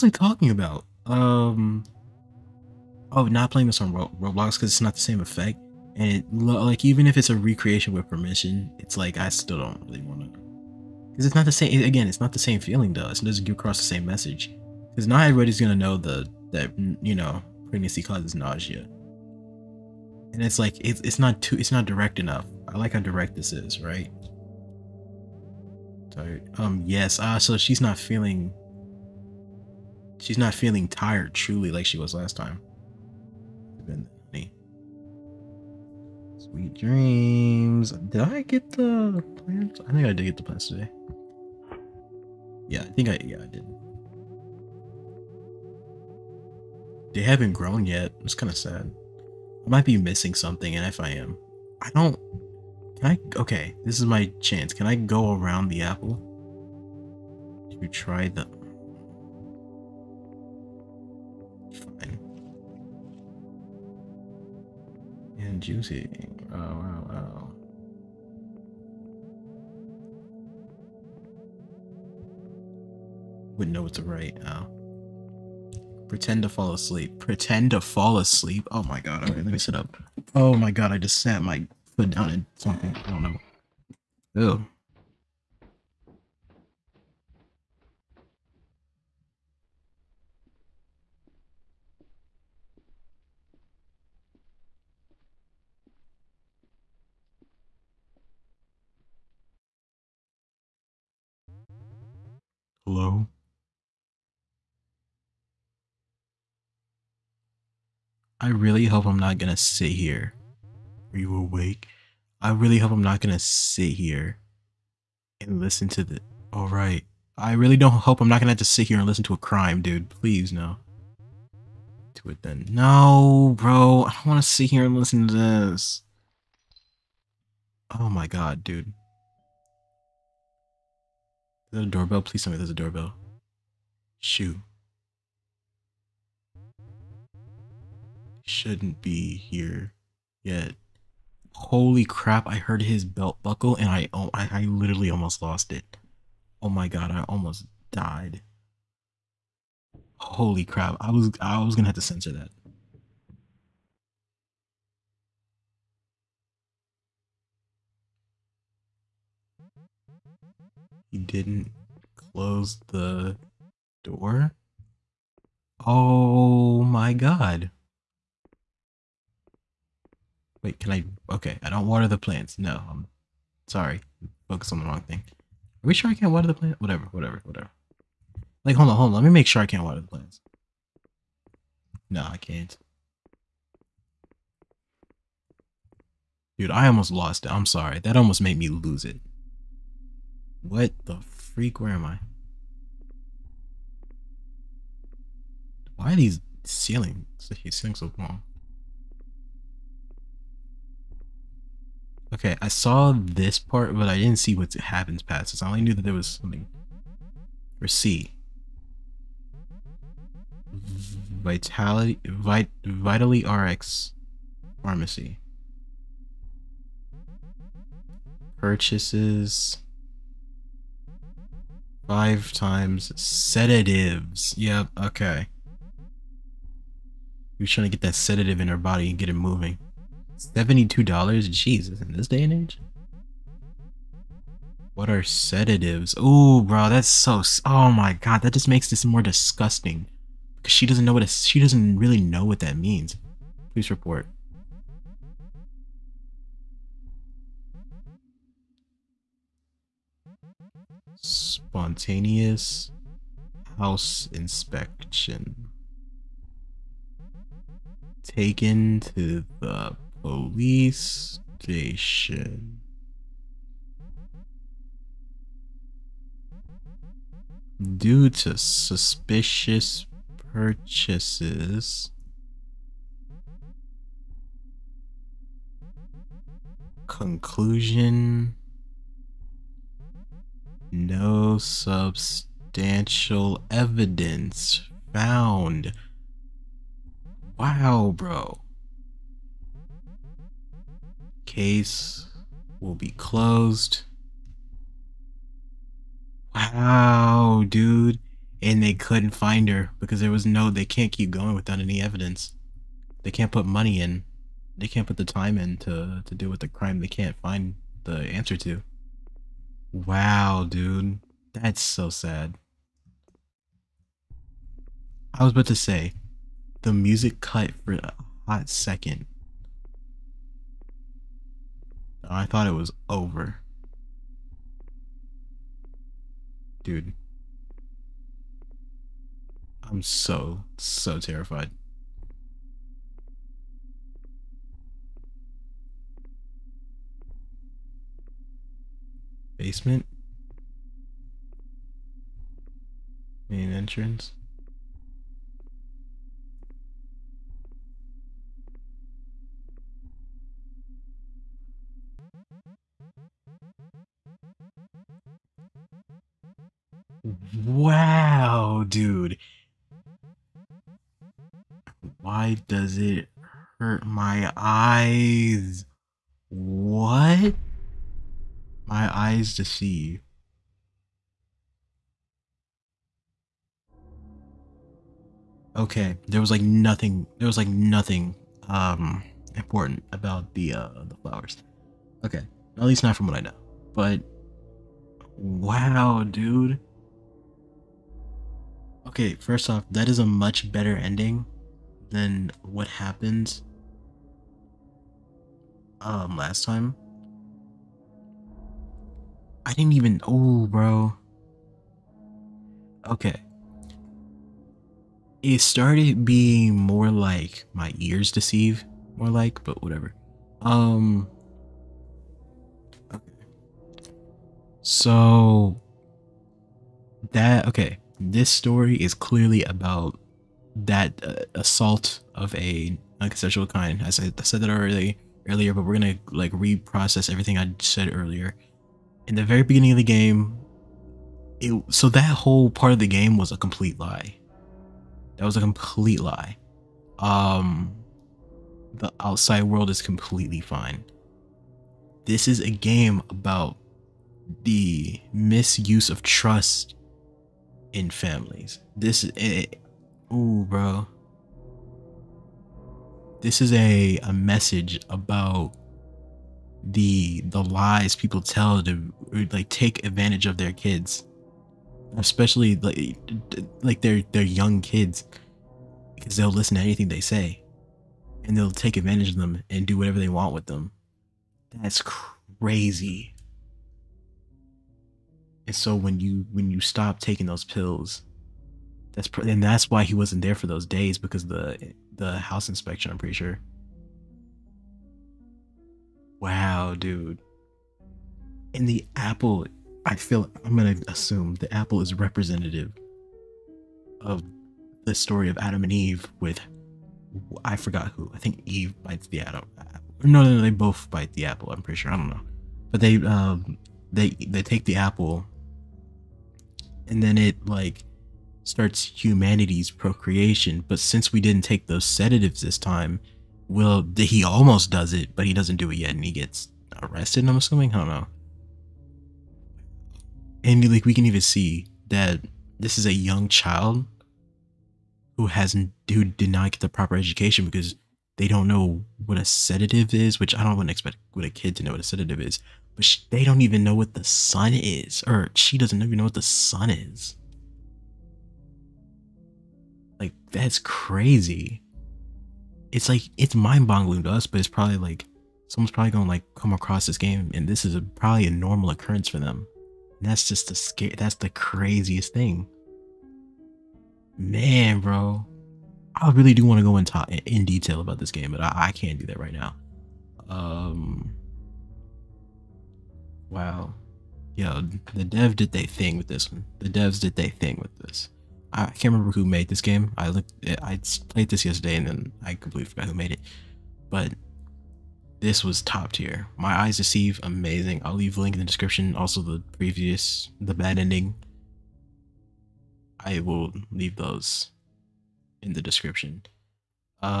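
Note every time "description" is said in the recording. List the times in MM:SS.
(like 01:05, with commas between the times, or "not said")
09:38, 09:45.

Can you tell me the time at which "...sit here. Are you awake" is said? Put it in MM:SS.
01:49.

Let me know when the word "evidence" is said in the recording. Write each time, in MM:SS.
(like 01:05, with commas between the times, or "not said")
04:43, 05:02.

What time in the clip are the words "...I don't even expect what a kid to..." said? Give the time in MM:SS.
08:50.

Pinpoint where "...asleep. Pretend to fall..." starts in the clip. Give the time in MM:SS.
01:16.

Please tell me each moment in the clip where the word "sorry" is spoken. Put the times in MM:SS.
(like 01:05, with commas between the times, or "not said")
02:53, 03:07.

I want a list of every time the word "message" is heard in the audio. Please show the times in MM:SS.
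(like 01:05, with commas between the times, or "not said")
00:14, 07:34.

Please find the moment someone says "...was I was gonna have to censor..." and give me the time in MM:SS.
02:31.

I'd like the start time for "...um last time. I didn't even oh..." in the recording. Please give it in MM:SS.
06:36.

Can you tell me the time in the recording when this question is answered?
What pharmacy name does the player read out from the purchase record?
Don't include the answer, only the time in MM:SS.
03:32.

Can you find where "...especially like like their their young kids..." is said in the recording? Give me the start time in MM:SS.
07:42.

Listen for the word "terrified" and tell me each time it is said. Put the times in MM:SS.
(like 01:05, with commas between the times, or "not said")
05:31.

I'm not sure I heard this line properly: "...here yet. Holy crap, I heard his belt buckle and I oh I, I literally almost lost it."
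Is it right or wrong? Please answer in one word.
right.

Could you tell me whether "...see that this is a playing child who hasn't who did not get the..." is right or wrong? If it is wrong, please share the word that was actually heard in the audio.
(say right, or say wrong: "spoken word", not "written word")
wrong: "young", not "playing".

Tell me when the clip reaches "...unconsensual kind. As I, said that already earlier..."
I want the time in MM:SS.
07:03.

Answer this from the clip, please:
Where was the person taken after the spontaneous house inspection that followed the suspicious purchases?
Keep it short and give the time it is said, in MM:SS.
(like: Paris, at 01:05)
Police station, at 04:20.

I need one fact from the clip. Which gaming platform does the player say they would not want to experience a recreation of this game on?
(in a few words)
Roblox.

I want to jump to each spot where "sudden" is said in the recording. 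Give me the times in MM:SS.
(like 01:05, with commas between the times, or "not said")
not said.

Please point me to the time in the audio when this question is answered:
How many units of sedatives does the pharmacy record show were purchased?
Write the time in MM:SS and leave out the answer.
03:42.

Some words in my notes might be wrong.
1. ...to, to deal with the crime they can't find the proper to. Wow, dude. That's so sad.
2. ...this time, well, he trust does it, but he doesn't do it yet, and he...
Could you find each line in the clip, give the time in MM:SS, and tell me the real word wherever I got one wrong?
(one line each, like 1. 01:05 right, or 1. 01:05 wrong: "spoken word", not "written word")
1. 05:05 wrong: "answer", not "proper"
2. 08:32 wrong: "almost", not "trust".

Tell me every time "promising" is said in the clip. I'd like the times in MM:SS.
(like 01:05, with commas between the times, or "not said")
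not said.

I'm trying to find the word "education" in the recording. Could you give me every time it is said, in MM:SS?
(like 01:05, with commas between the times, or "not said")
08:47.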